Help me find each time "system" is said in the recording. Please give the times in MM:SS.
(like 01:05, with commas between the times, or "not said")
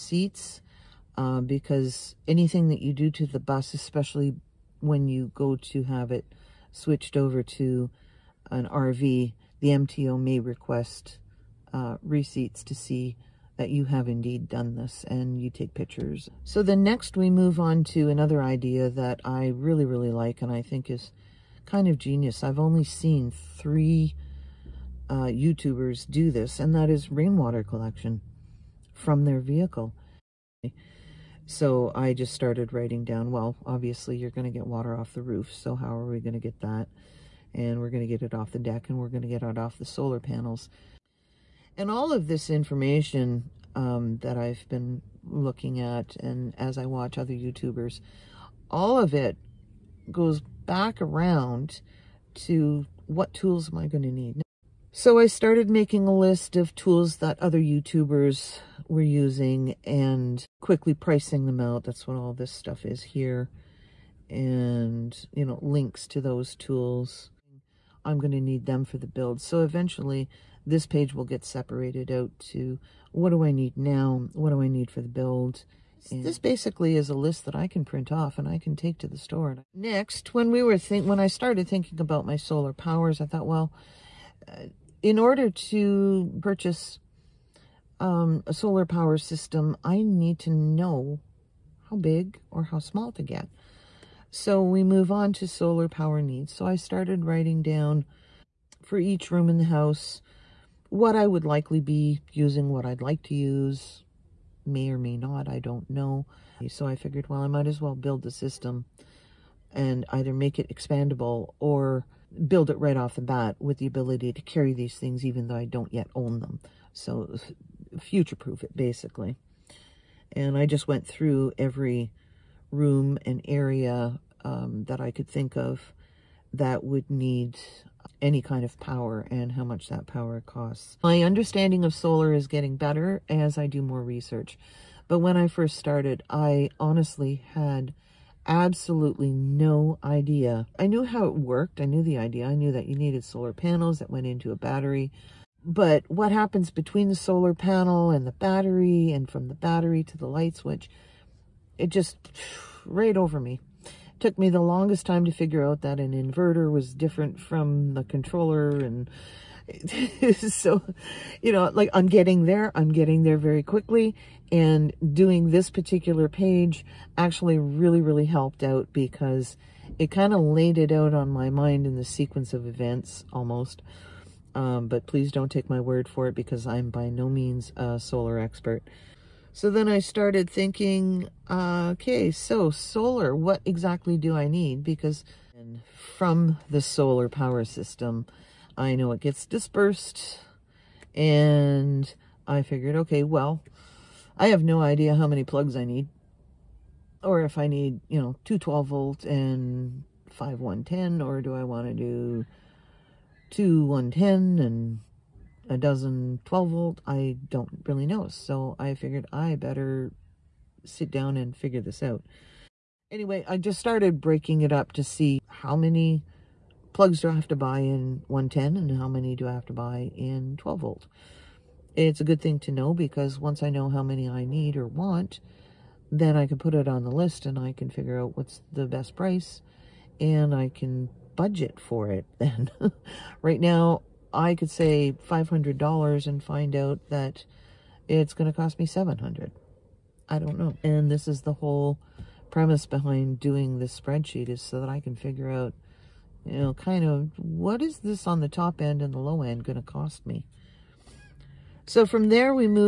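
01:29, 01:48, 03:07.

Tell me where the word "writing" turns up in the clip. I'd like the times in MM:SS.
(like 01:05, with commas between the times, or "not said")
00:32, 01:37.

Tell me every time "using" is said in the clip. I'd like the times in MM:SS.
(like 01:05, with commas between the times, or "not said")
00:59, 01:42.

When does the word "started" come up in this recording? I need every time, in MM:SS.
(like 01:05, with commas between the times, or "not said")
00:32, 00:55, 01:21, 01:36, 02:15, 02:59, 03:33.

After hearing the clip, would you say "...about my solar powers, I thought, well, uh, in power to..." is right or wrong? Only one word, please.
wrong.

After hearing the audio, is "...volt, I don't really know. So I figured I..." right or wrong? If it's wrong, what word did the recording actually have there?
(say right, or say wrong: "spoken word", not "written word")
right.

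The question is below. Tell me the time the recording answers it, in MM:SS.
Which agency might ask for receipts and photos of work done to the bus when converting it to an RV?
00:09.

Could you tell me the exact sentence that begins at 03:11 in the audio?
And I figured, okay, well, I have no idea how many plugs I need.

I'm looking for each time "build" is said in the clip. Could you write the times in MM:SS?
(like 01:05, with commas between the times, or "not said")
01:09, 01:15, 01:47, 01:52.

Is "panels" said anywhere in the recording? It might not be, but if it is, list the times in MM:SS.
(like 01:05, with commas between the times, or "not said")
00:40, 02:23, 02:27.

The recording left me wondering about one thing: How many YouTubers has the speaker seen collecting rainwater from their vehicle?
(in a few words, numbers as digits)
3.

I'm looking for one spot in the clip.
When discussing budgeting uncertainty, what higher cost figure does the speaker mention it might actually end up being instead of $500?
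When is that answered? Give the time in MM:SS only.
03:58.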